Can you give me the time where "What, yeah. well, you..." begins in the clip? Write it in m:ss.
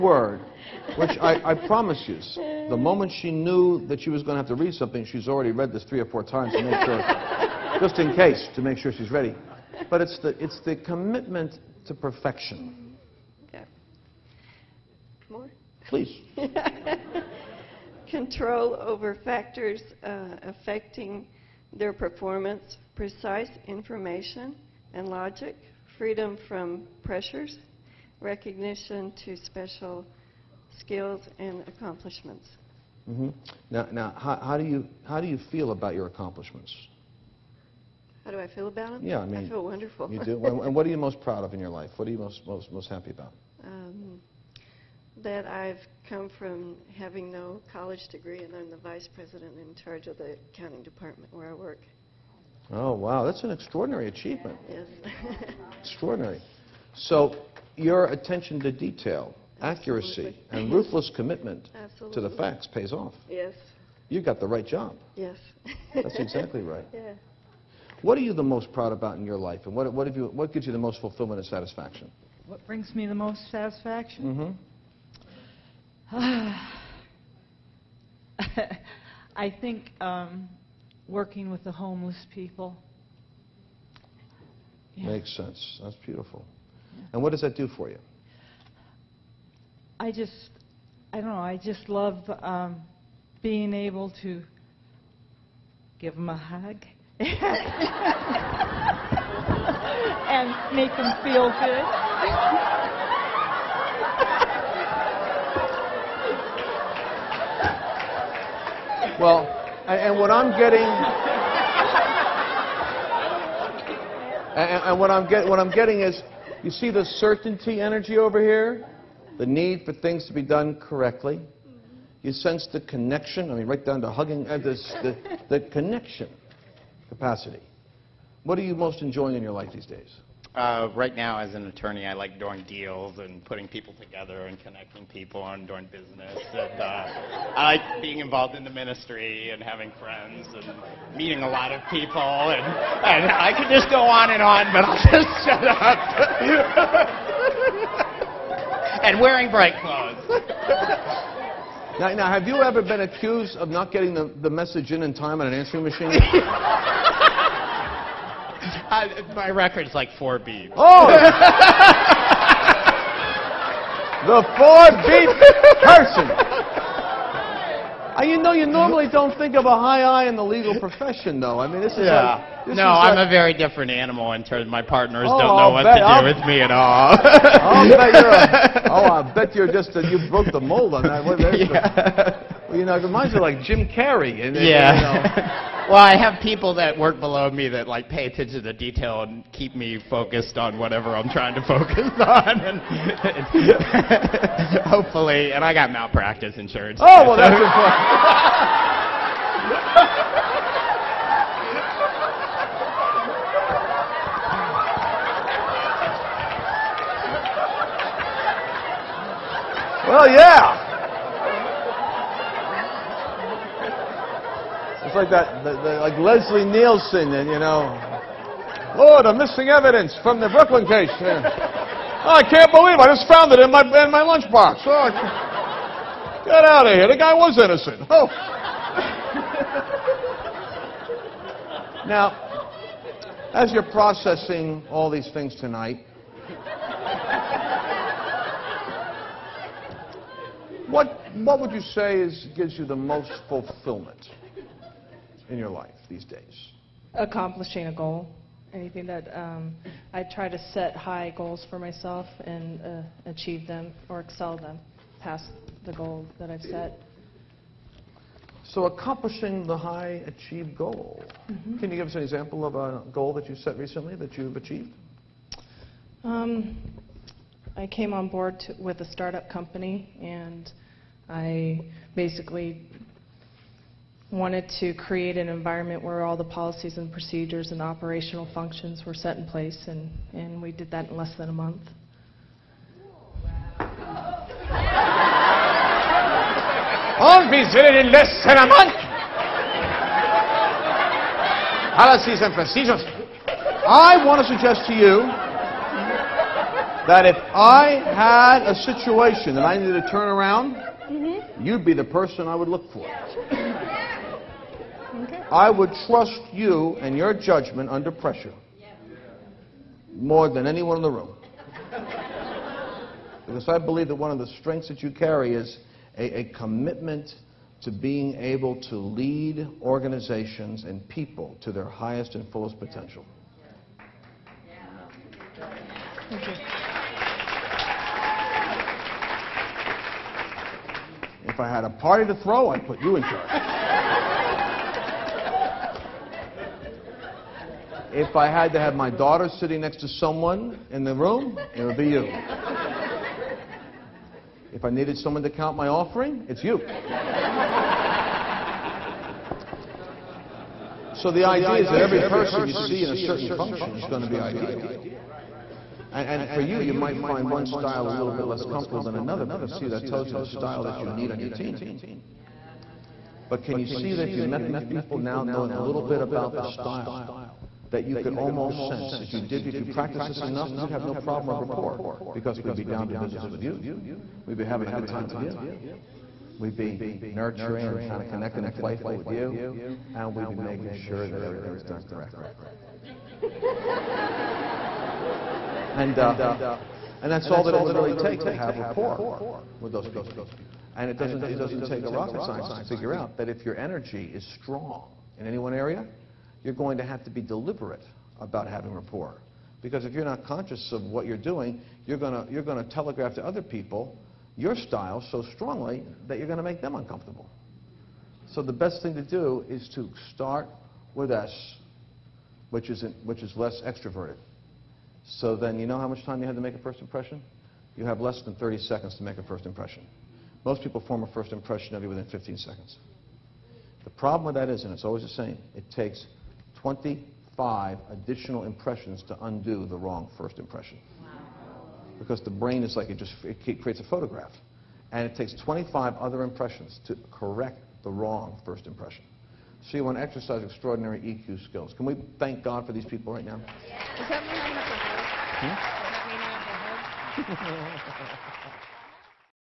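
3:01.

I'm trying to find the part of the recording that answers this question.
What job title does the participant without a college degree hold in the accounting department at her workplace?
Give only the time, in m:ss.
0:48.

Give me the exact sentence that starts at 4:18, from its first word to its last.
So accomplishing the high achieved goal.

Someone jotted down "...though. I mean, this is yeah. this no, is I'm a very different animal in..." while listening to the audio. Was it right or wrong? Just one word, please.
right.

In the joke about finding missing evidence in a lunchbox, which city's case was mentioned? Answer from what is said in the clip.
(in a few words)
Brooklyn.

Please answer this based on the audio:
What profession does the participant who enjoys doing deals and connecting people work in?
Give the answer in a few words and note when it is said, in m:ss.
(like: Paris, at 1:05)
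Attorney, at 2:11.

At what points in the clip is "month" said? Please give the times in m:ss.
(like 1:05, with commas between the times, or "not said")
4:41, 4:48.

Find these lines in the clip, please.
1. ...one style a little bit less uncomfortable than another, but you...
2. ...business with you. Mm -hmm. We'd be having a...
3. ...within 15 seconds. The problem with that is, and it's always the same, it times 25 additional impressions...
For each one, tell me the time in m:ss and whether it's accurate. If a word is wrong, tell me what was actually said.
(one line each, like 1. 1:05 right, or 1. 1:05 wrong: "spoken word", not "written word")
1. 5:57 wrong: "comfortable", not "uncomfortable"
2. 6:13 right
3. 7:02 wrong: "takes", not "times".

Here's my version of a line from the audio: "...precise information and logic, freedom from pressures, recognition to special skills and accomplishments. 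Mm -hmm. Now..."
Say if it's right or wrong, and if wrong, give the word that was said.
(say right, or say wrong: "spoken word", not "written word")
right.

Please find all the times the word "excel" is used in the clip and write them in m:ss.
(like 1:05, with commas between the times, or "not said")
4:14.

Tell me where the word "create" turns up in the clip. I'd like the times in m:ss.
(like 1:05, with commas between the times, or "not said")
4:34, 7:13.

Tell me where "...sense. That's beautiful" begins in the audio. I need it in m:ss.
1:25.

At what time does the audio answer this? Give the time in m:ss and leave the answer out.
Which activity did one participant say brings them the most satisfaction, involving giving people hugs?
1:21.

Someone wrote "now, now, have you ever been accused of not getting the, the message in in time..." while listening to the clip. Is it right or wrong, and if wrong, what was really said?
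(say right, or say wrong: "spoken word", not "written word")
right.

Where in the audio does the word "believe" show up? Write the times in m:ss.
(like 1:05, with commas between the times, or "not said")
3:42, 5:13.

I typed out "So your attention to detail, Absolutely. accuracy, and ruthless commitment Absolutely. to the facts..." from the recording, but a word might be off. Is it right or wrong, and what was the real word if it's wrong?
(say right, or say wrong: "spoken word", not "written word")
right.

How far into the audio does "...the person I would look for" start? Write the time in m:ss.
5:02.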